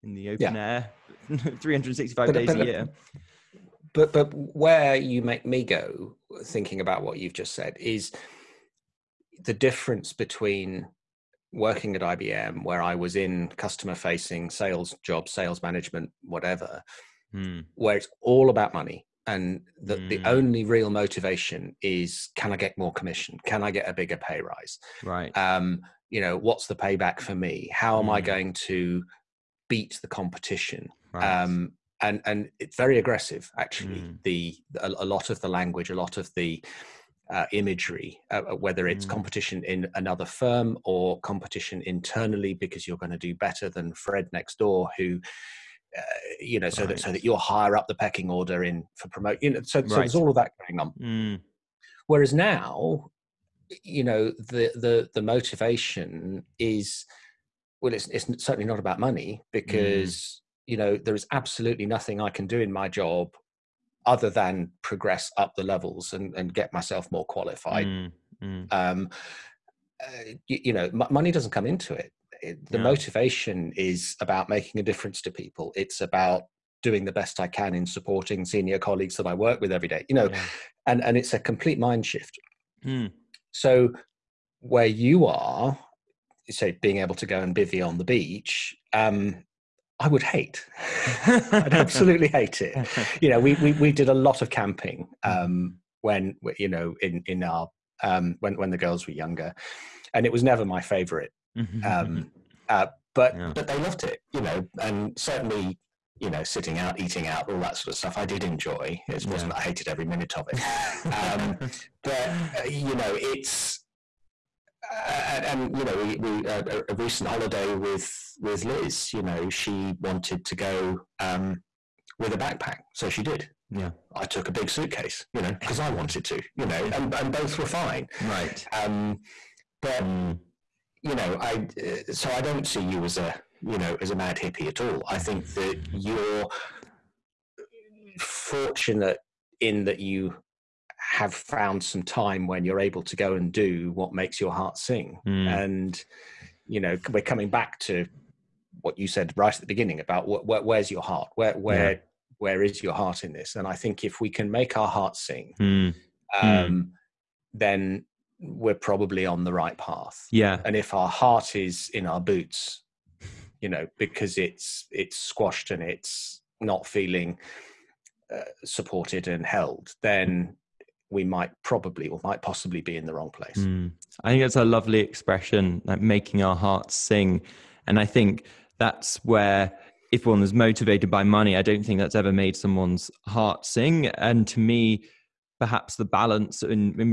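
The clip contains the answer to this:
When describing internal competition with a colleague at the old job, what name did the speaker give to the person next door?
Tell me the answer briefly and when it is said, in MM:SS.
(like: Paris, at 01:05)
Fred, at 00:43.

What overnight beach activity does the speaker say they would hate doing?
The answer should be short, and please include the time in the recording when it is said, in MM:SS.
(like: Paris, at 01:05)
Bivy, at 01:27.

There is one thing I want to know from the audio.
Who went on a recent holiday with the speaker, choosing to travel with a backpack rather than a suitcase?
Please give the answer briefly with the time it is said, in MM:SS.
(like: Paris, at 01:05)
Liz, at 01:58.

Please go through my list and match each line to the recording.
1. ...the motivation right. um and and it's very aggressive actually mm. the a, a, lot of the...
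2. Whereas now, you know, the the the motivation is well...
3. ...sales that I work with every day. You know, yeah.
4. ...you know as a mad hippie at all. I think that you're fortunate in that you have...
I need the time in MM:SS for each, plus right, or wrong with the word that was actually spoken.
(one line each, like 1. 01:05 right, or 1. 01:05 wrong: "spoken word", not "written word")
1. 00:30 wrong: "competition", not "motivation"
2. 00:52 right
3. 01:18 wrong: "colleagues", not "sales"
4. 02:13 right.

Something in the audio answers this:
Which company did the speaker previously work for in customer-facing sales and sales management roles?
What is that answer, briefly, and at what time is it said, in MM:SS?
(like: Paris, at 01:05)
IBM, at 00:12.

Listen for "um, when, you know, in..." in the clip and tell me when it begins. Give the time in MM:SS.
01:35.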